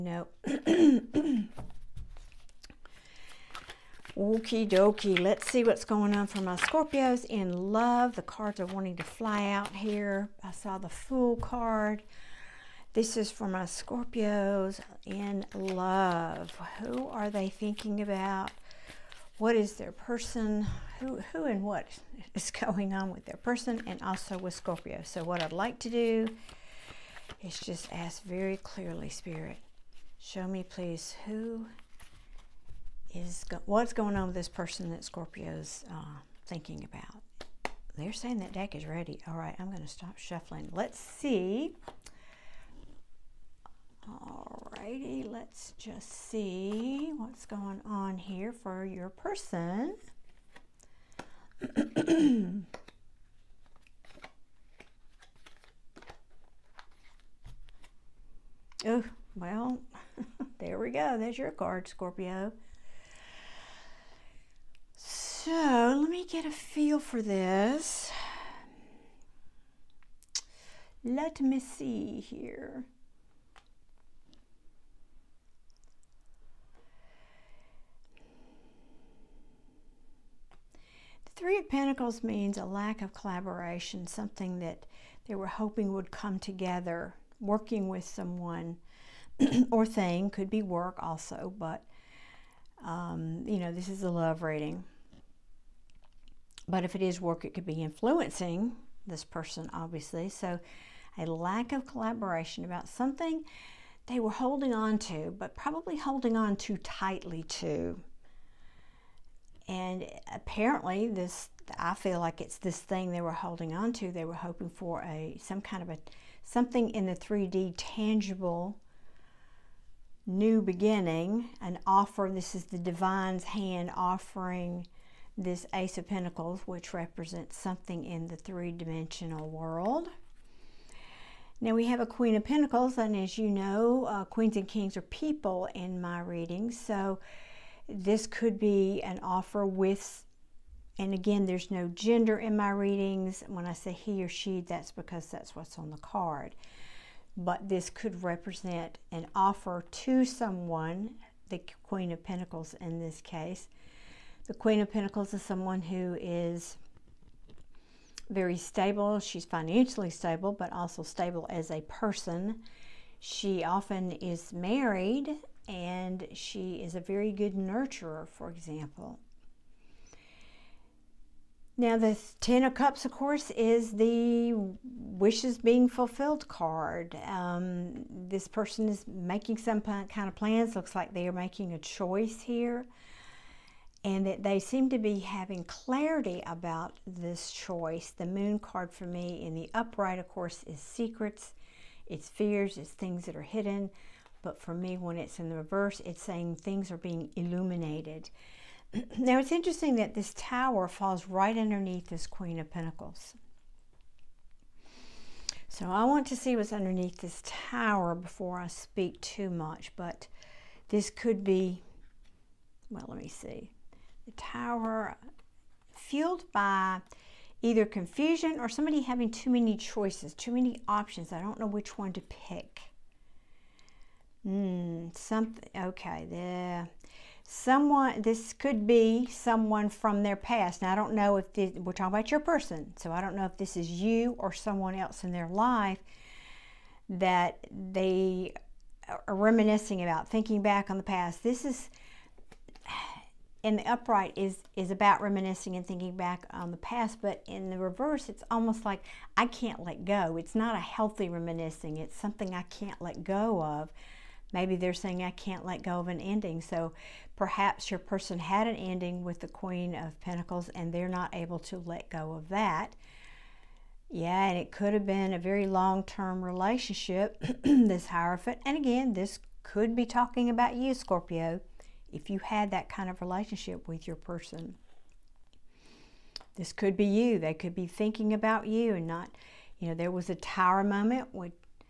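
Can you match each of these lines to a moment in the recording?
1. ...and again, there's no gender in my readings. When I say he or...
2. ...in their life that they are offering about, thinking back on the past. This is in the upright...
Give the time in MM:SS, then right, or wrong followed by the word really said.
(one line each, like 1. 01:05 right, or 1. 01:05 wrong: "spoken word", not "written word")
1. 02:20 right
2. 03:55 wrong: "reminiscing", not "offering".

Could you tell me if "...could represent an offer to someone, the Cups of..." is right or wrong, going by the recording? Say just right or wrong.
wrong.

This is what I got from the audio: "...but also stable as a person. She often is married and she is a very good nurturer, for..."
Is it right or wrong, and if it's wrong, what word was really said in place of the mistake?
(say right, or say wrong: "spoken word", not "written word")
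right.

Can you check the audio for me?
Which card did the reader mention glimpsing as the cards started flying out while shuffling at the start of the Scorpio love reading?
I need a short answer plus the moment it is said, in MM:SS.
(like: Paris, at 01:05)
The Fool, at 00:10.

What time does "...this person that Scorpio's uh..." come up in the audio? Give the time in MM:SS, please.
00:34.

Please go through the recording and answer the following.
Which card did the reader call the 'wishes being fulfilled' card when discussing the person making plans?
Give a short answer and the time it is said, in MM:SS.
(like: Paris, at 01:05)
Ten of Cups, at 02:52.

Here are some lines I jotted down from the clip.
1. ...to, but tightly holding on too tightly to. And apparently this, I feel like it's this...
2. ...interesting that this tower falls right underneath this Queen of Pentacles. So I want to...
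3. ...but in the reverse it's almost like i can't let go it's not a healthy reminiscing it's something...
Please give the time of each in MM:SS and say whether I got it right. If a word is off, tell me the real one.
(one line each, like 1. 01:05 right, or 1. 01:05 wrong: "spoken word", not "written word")
1. 01:44 wrong: "probably", not "tightly"
2. 03:19 right
3. 04:07 right.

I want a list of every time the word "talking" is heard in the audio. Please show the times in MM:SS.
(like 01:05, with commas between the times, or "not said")
03:51, 04:30.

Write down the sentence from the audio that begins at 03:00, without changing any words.
Looks like they are making a choice here and that they seem to be having clarity about this choice.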